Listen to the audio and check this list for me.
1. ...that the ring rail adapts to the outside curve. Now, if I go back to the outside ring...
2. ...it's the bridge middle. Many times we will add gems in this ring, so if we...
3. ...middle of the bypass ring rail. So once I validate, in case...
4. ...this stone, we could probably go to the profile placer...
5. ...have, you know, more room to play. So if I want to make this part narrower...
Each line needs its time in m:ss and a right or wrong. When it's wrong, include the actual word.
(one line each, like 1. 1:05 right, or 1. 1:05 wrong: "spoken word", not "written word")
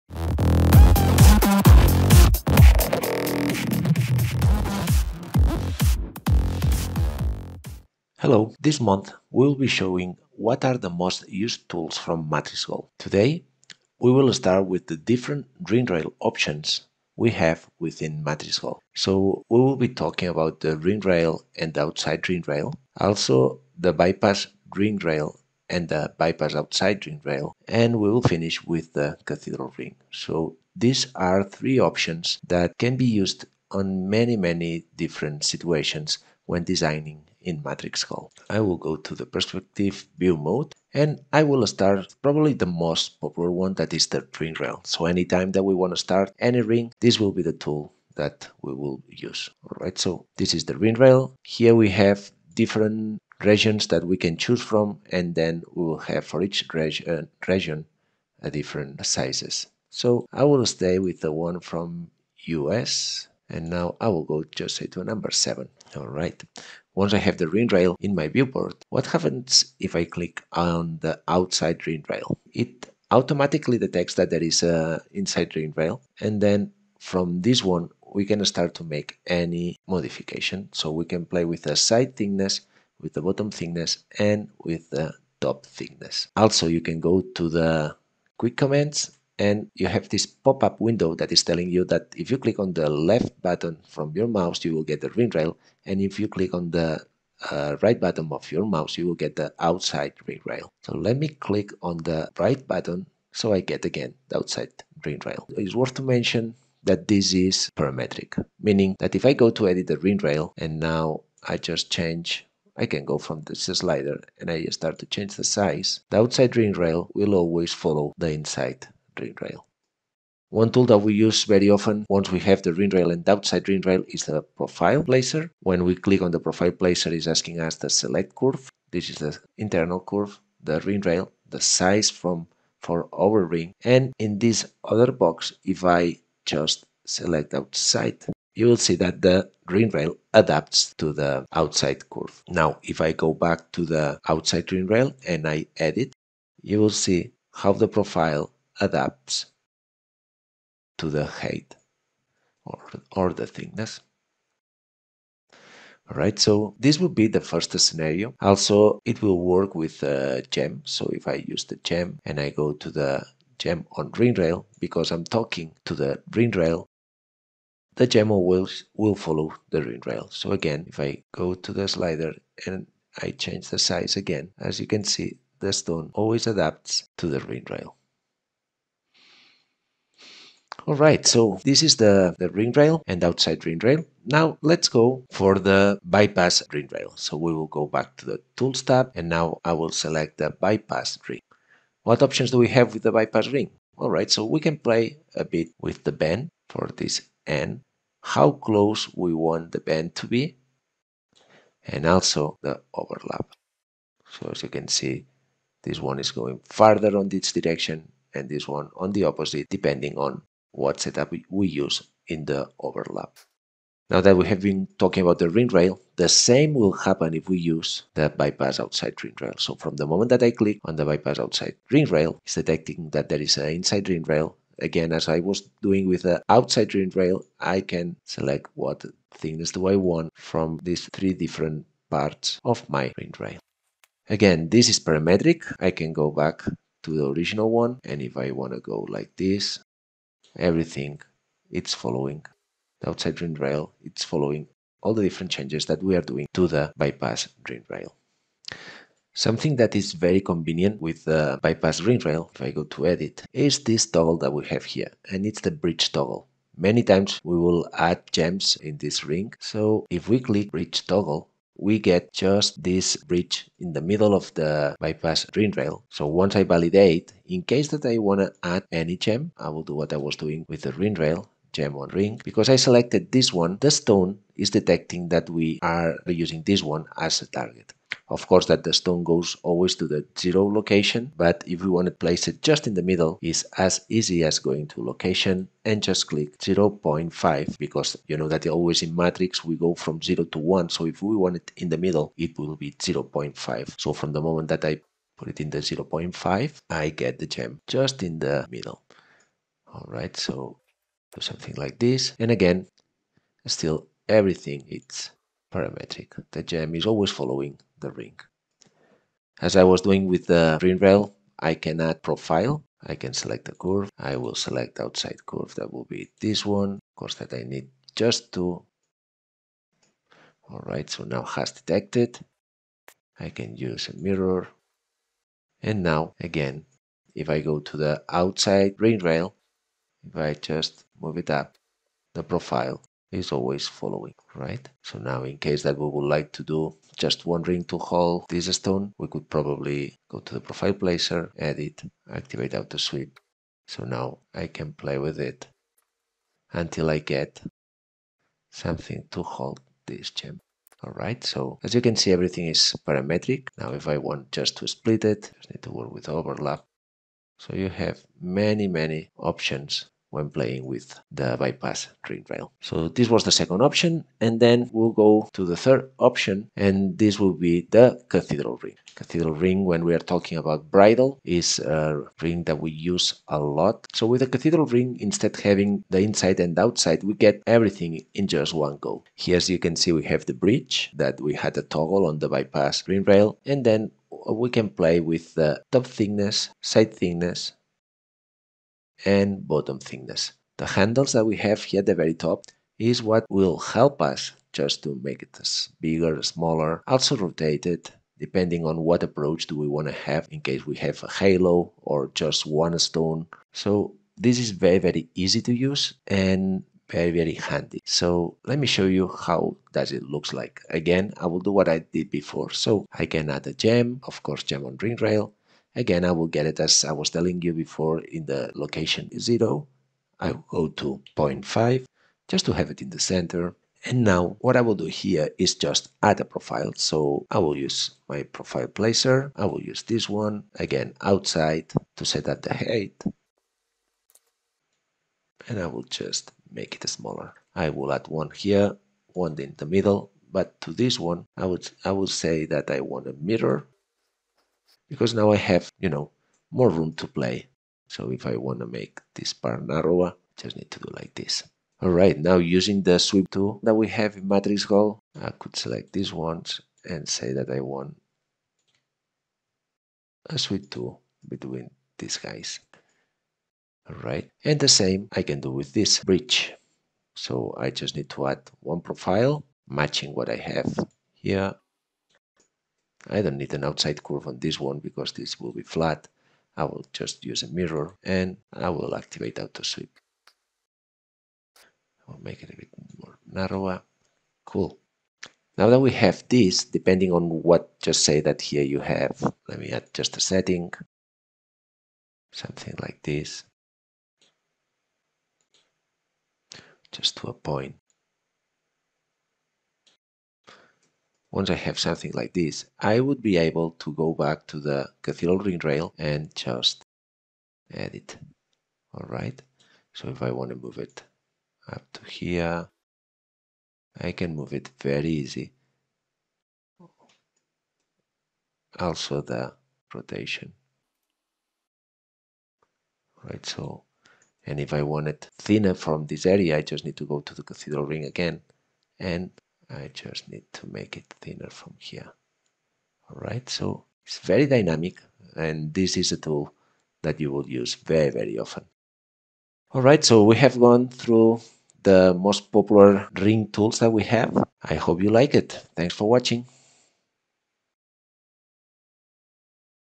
1. 2:18 right
2. 4:15 wrong: "toggle", not "middle"
3. 4:24 right
4. 5:38 right
5. 7:25 right.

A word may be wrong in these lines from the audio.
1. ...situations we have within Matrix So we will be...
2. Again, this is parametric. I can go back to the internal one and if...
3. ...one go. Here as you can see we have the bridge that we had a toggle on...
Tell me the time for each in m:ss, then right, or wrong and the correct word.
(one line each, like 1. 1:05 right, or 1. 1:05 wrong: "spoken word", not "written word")
1. 0:16 wrong: "options", not "situations"
2. 3:54 wrong: "original", not "internal"
3. 6:18 right.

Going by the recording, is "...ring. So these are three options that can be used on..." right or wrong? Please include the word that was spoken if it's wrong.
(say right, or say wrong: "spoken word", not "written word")
right.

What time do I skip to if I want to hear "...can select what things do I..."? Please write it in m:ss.
3:47.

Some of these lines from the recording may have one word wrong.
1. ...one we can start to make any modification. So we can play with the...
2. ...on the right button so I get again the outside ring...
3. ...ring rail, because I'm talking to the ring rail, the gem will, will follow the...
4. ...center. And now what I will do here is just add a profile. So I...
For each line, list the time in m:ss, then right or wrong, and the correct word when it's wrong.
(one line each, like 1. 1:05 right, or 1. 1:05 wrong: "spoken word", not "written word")
1. 1:17 right
2. 1:41 right
3. 2:44 right
4. 7:03 right.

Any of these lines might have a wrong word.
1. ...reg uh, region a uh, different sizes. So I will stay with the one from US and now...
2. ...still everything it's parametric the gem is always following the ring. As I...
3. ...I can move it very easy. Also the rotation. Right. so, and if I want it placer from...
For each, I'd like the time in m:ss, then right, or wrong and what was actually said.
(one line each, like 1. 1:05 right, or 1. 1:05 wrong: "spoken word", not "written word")
1. 0:56 right
2. 5:03 right
3. 8:34 wrong: "thinner", not "placer".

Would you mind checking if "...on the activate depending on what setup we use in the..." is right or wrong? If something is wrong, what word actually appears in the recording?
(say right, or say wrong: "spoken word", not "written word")
wrong: "opposite", not "activate".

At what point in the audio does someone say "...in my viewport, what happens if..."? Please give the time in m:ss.
1:07.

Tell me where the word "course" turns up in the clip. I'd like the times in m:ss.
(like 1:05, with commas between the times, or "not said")
4:38, 5:17, 6:54.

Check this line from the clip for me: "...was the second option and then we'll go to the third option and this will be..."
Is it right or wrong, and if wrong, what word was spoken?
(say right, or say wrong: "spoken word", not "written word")
right.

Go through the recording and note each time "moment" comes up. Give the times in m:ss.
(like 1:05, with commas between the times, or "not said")
3:40, 4:54.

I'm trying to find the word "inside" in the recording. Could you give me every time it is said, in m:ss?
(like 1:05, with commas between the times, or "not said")
1:15, 1:58, 3:43, 6:16.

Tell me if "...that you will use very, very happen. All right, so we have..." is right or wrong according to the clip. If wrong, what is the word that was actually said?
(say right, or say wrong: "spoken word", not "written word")
wrong: "often", not "happen".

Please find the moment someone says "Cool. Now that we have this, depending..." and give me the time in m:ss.
8:04.